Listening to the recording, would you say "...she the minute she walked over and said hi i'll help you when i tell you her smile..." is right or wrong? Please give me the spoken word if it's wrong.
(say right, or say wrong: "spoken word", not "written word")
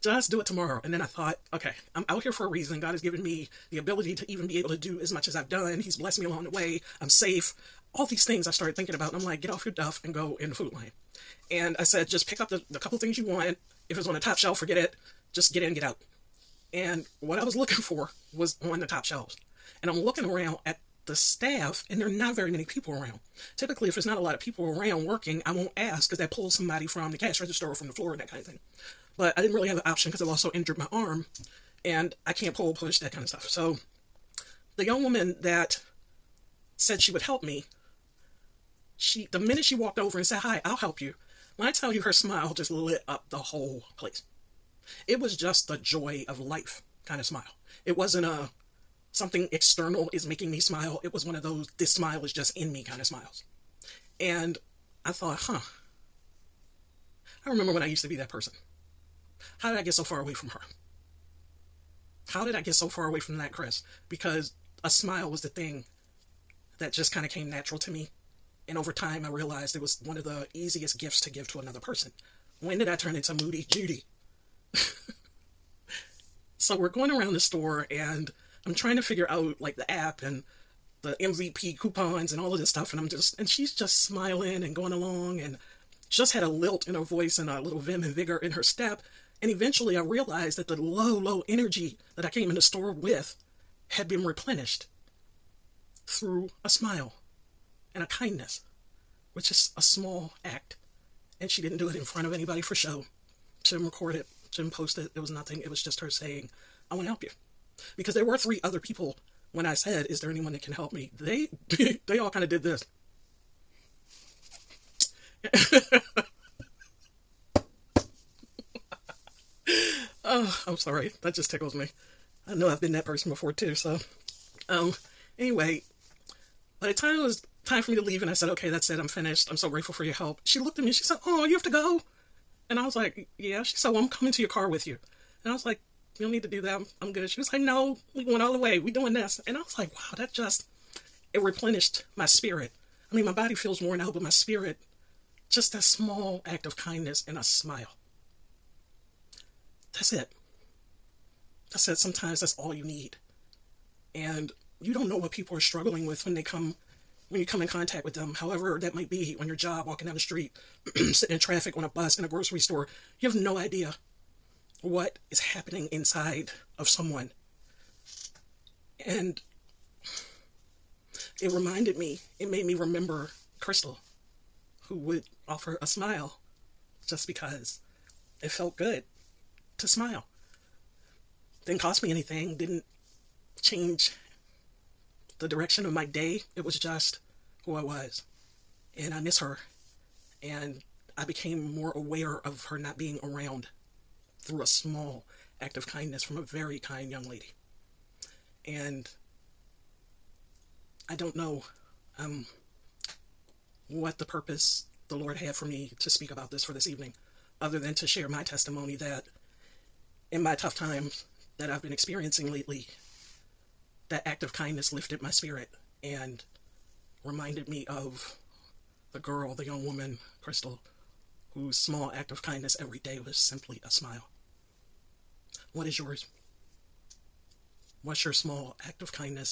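right.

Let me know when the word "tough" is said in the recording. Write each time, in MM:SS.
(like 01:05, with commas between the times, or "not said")
03:30.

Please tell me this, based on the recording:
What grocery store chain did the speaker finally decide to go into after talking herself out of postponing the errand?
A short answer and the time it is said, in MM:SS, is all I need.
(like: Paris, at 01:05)
Food Lion, at 00:10.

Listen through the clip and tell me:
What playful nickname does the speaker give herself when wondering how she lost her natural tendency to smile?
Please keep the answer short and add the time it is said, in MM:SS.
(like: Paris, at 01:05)
Moody Judy, at 01:13.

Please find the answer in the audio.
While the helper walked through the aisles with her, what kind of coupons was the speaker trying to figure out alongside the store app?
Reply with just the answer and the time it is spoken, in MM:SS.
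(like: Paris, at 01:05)
MVP coupons, at 01:21.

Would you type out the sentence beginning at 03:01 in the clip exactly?
Didn't cost me anything, didn't change the direction of my day.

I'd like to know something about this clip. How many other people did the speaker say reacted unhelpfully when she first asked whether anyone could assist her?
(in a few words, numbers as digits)
3.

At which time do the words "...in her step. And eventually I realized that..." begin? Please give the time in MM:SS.
01:28.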